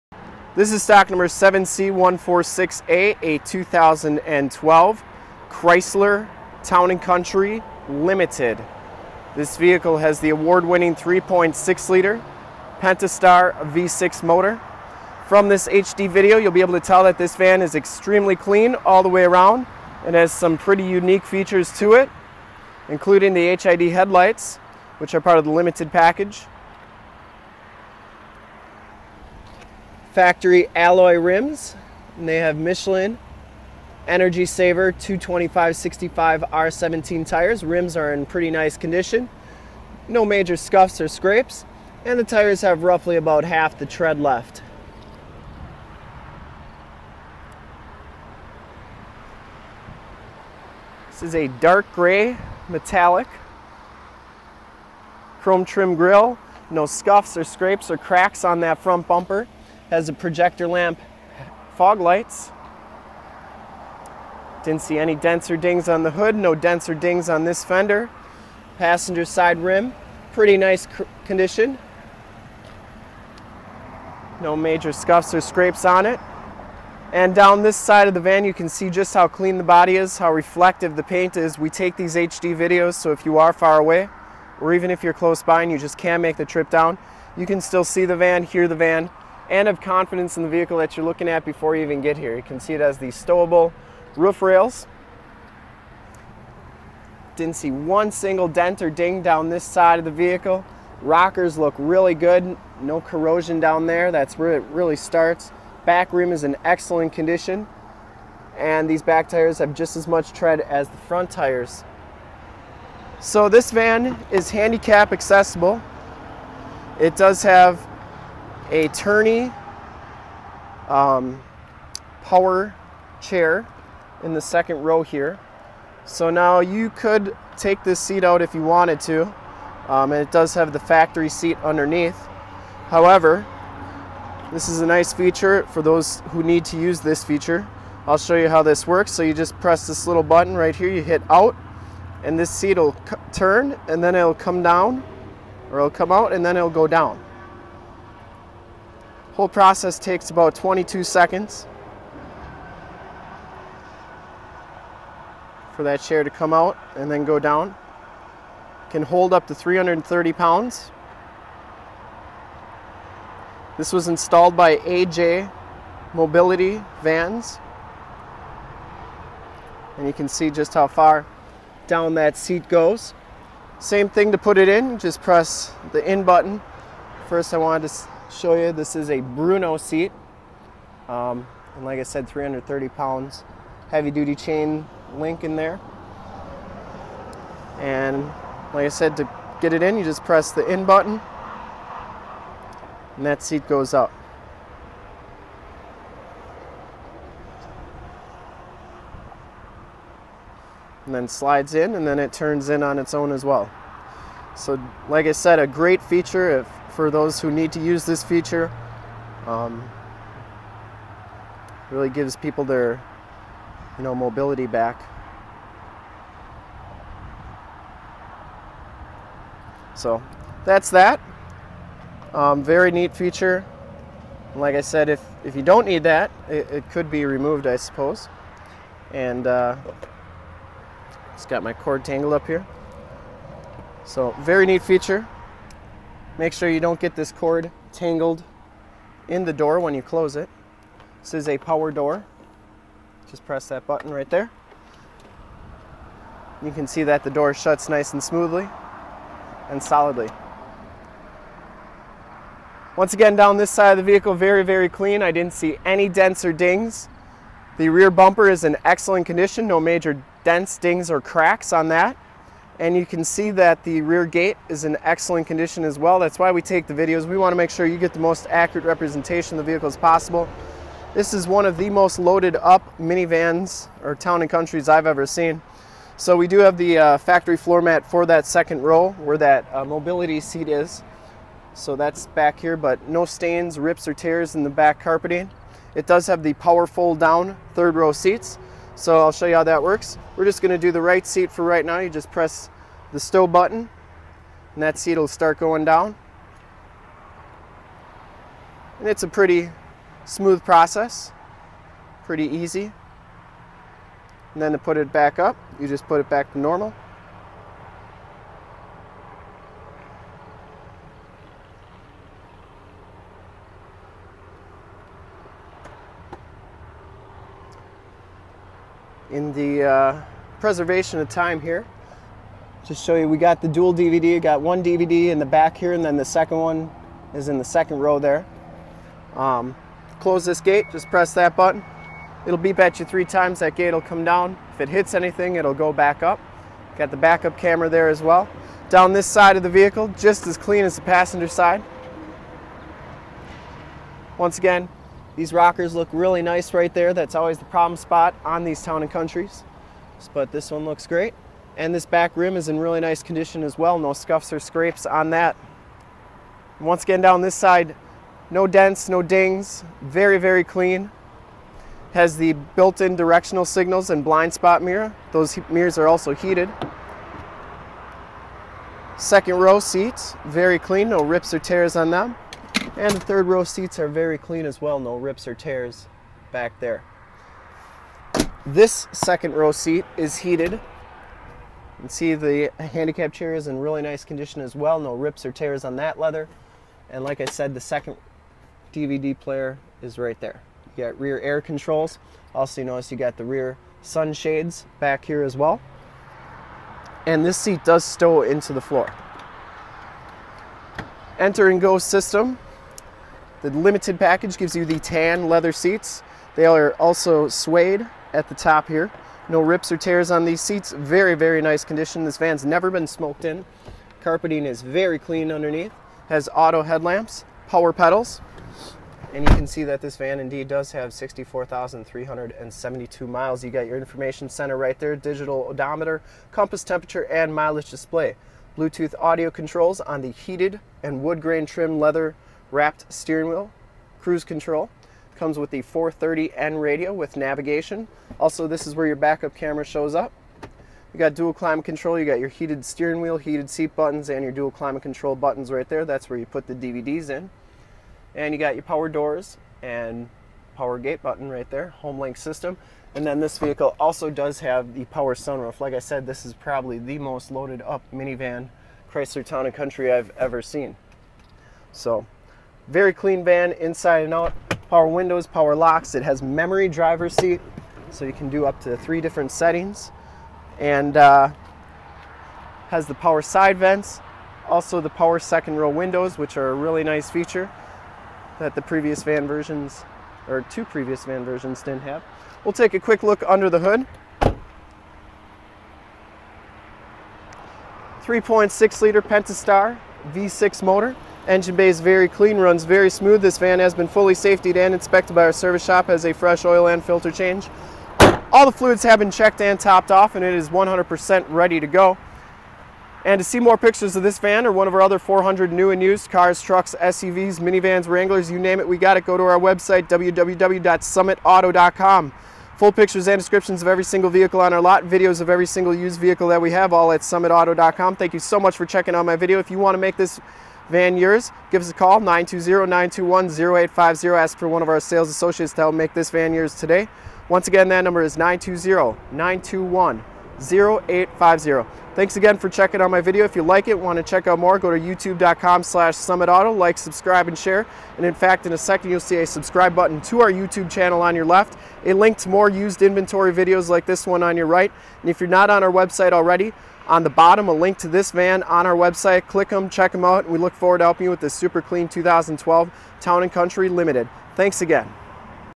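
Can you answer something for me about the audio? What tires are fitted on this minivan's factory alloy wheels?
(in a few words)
Michelin Energy Saver.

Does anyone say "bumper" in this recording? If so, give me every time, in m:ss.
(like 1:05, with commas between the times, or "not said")
0:59, 4:18.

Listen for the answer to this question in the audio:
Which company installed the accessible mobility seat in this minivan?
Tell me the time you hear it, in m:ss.
2:44.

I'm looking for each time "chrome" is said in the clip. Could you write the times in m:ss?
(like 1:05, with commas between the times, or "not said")
0:55.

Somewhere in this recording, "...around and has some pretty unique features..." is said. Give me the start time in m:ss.
0:19.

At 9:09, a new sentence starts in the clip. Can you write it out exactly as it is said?
Click them, check them out, and we look forward to helping you with this super clean 2012 Town & Country Limited.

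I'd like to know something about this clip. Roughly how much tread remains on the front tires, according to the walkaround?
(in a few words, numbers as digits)
half.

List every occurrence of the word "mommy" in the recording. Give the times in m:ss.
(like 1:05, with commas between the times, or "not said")
not said.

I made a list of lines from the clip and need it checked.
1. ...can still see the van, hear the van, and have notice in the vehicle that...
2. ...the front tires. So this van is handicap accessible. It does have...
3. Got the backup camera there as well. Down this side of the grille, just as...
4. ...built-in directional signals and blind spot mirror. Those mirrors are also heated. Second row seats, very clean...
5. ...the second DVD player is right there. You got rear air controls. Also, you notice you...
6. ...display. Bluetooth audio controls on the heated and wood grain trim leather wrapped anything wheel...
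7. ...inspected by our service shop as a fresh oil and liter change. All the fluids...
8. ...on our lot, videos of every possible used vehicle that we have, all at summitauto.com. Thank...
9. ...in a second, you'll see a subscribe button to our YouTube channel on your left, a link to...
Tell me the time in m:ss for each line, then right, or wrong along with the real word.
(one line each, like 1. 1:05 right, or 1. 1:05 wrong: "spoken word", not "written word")
1. 1:27 wrong: "confidence", not "notice"
2. 1:50 right
3. 5:36 wrong: "vehicle", not "grille"
4. 6:02 right
5. 6:27 right
6. 7:07 wrong: "steering", not "anything"
7. 8:14 wrong: "filter", not "liter"
8. 8:34 wrong: "single", not "possible"
9. 8:58 right.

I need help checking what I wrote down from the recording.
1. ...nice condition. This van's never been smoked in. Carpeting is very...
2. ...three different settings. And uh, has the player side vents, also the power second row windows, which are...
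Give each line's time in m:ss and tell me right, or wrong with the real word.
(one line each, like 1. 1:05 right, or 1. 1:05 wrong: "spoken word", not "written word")
1. 6:51 right
2. 7:48 wrong: "power", not "player".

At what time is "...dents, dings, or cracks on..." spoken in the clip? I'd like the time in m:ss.
4:20.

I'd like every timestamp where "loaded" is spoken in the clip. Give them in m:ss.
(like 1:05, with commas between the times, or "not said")
4:32, 7:37.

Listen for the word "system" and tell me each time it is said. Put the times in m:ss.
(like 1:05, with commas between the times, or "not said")
6:41, 7:32.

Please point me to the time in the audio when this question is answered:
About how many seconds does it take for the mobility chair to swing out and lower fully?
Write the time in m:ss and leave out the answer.
2:30.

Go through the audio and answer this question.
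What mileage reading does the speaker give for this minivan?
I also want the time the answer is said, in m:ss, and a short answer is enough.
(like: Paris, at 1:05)
64,372, at 7:01.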